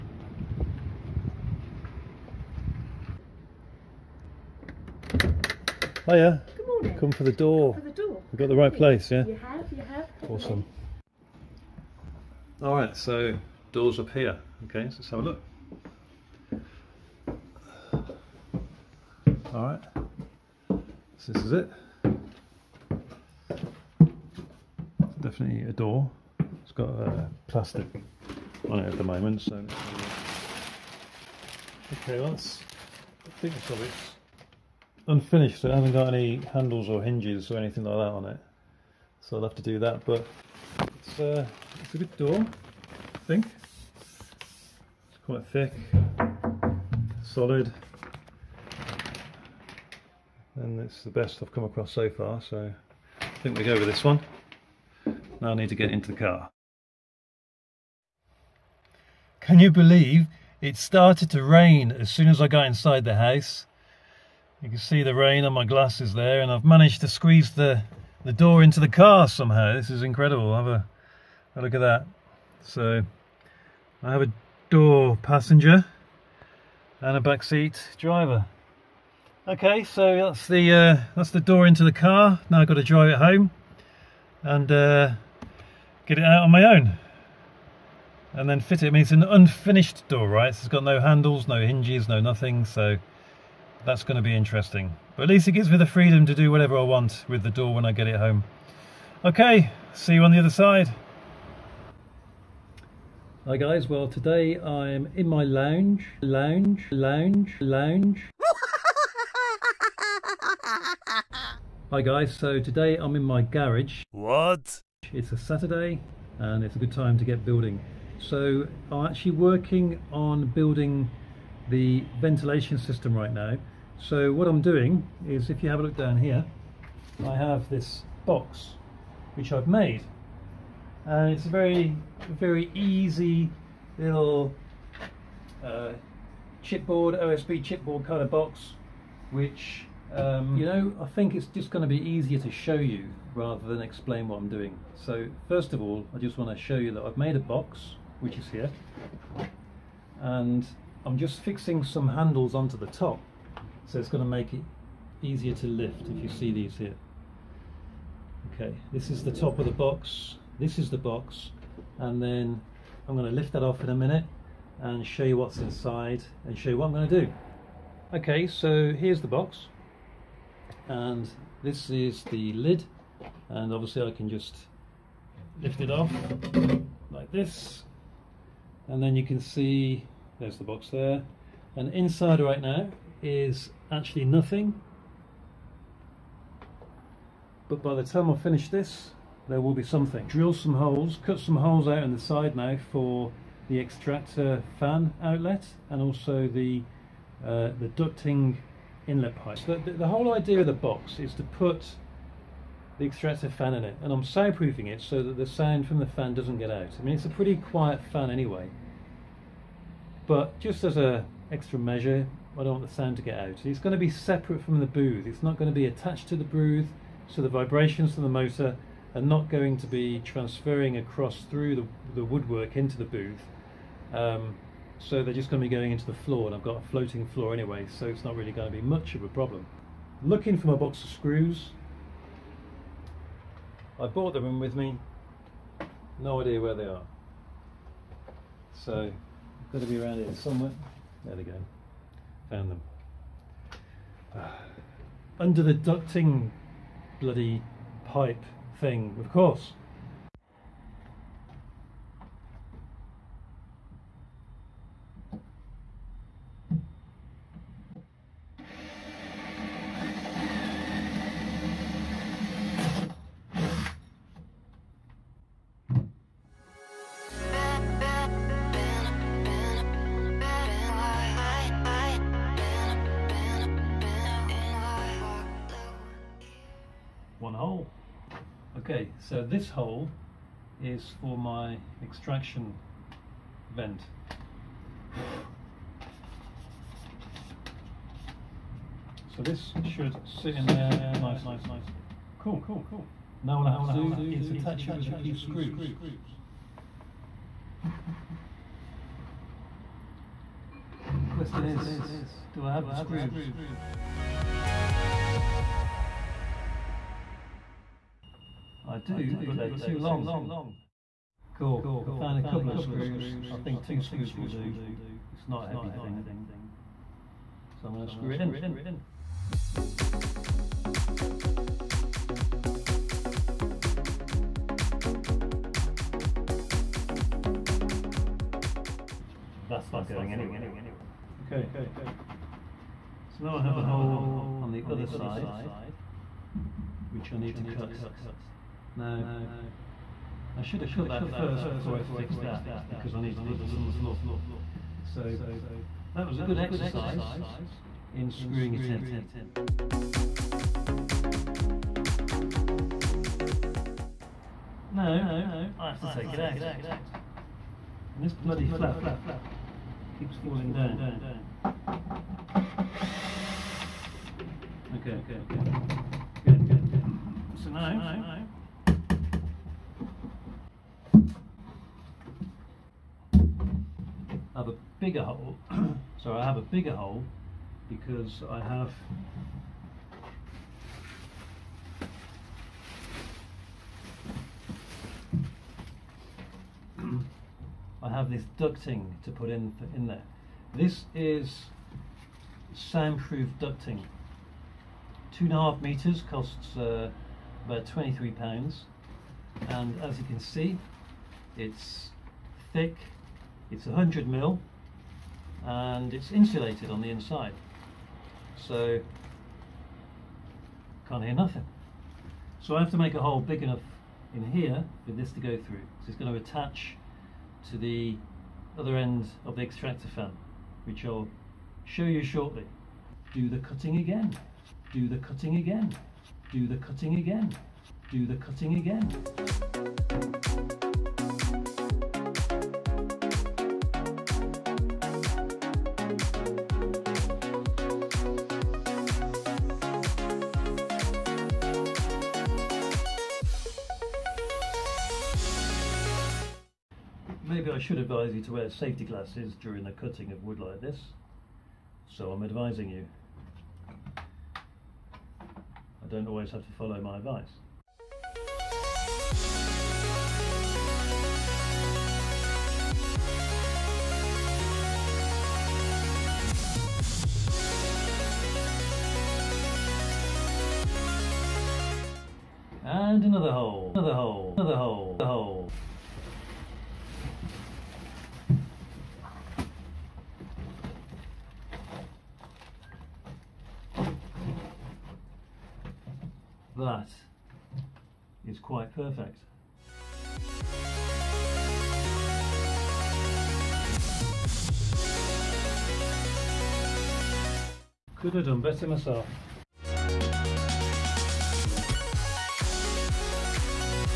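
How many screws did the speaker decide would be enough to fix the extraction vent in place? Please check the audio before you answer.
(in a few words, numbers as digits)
2.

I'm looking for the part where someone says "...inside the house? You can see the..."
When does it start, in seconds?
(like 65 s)
62 s.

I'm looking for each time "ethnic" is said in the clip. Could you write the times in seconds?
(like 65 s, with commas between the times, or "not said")
not said.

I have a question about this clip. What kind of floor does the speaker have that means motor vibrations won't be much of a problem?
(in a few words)
Floating floor.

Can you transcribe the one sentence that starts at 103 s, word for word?
Hi guys, well today I'm in my lounge, lounge, lounge, lounge.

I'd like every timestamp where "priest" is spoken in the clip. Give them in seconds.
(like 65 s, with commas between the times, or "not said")
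not said.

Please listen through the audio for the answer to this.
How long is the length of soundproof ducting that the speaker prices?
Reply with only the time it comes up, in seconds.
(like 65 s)
395 s.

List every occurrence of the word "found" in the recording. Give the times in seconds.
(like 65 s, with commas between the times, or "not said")
242 s, 312 s.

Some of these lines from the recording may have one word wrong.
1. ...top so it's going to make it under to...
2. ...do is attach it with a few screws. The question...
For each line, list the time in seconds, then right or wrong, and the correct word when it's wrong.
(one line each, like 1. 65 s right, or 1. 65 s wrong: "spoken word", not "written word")
1. 152 s wrong: "easier", not "under"
2. 293 s right.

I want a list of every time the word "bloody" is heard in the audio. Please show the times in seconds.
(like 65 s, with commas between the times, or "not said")
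247 s, 358 s.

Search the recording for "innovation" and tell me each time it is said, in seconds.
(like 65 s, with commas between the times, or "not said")
not said.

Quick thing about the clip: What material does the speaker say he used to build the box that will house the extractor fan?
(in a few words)
OSB chipboard.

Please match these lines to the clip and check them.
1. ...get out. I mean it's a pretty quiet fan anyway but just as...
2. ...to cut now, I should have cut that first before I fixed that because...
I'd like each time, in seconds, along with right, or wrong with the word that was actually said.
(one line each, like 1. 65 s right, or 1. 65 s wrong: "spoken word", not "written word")
1. 206 s right
2. 337 s right.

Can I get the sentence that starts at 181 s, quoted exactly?
And inside right now is actually nothing.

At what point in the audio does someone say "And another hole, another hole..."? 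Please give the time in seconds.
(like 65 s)
472 s.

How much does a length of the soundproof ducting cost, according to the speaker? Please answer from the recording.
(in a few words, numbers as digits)
£23.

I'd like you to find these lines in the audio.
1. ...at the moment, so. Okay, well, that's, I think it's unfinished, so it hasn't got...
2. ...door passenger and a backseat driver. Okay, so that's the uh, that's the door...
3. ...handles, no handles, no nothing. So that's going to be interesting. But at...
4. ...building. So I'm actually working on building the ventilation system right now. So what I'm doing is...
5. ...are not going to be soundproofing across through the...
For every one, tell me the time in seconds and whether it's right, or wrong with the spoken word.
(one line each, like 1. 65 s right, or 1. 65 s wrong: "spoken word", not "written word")
1. 28 s right
2. 74 s right
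3. 90 s wrong: "hinges", not "handles"
4. 117 s right
5. 219 s wrong: "transferring", not "soundproofing".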